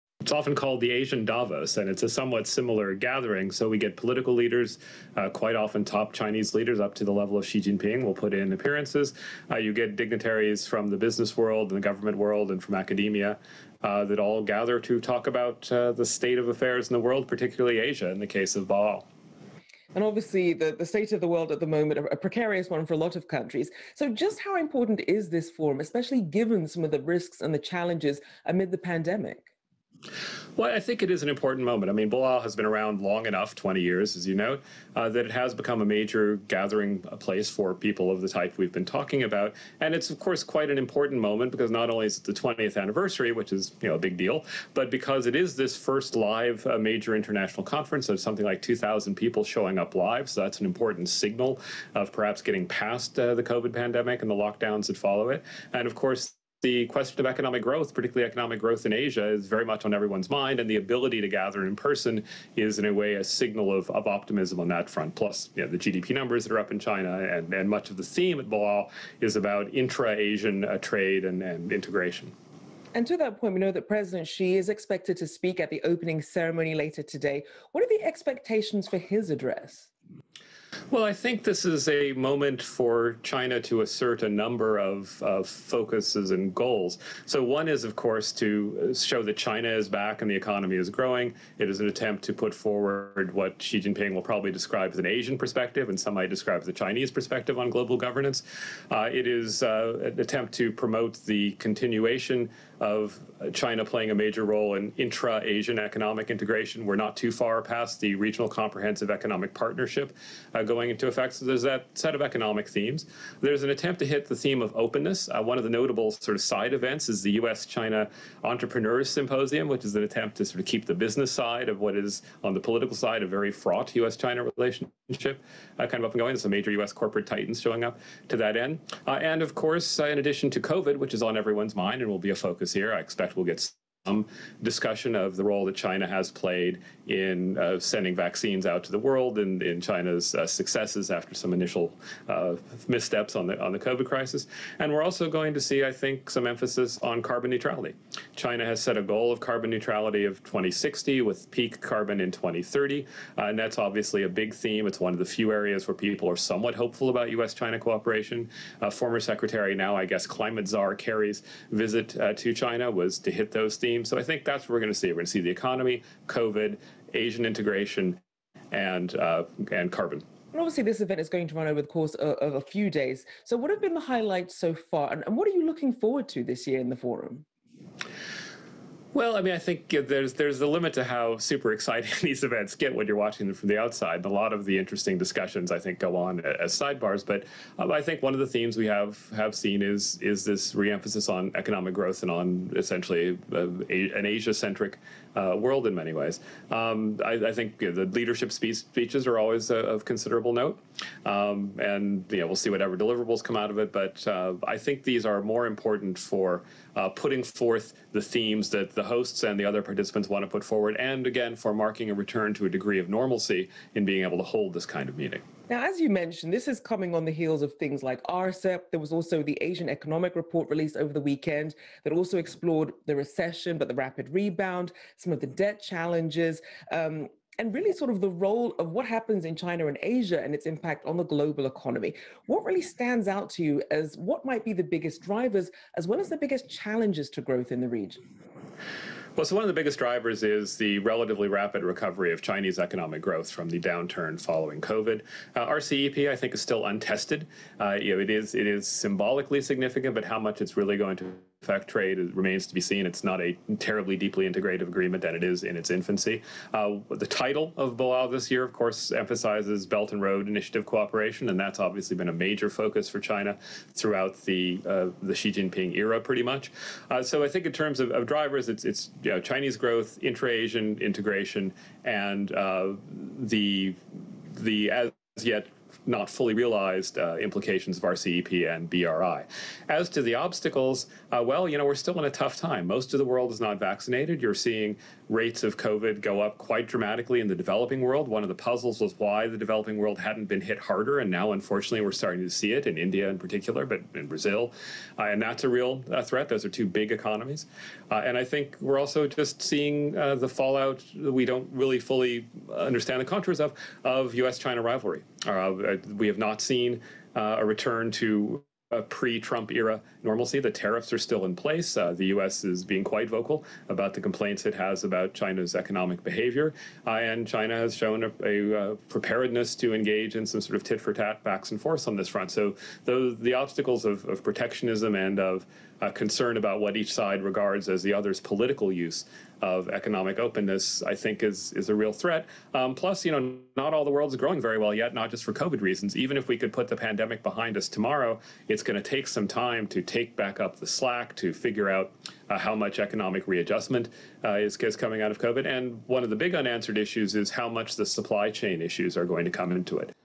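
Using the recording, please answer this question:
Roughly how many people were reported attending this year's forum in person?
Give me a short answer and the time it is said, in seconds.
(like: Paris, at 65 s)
2,000, at 48 s.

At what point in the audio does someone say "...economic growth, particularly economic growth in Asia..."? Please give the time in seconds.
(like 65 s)
57 s.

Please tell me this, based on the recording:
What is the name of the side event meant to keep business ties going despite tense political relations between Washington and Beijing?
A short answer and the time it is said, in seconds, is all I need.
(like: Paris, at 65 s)
US China Entrepreneurs Symposium, at 117 s.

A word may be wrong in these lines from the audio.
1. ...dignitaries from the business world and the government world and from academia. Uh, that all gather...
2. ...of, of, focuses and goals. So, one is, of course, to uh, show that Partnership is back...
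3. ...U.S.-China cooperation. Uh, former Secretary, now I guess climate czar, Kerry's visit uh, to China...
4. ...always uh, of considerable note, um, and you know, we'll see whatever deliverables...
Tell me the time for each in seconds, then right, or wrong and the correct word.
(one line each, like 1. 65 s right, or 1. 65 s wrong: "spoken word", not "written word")
1. 9 s right
2. 84 s wrong: "China", not "Partnership"
3. 157 s right
4. 199 s right.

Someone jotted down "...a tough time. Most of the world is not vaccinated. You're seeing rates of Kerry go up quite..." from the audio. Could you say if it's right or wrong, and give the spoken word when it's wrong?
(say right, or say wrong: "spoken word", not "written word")
wrong: "COVID", not "Kerry".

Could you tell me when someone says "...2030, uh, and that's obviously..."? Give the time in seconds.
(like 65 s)
152 s.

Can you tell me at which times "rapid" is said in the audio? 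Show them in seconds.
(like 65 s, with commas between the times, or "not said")
223 s, 241 s.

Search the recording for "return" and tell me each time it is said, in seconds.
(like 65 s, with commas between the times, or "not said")
212 s, 307 s.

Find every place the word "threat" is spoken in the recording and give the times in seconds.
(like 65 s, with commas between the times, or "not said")
296 s, 332 s.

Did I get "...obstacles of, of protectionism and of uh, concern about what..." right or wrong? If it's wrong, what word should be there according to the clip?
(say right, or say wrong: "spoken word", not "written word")
right.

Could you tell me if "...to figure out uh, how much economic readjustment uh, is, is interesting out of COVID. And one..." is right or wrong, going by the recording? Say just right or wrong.
wrong.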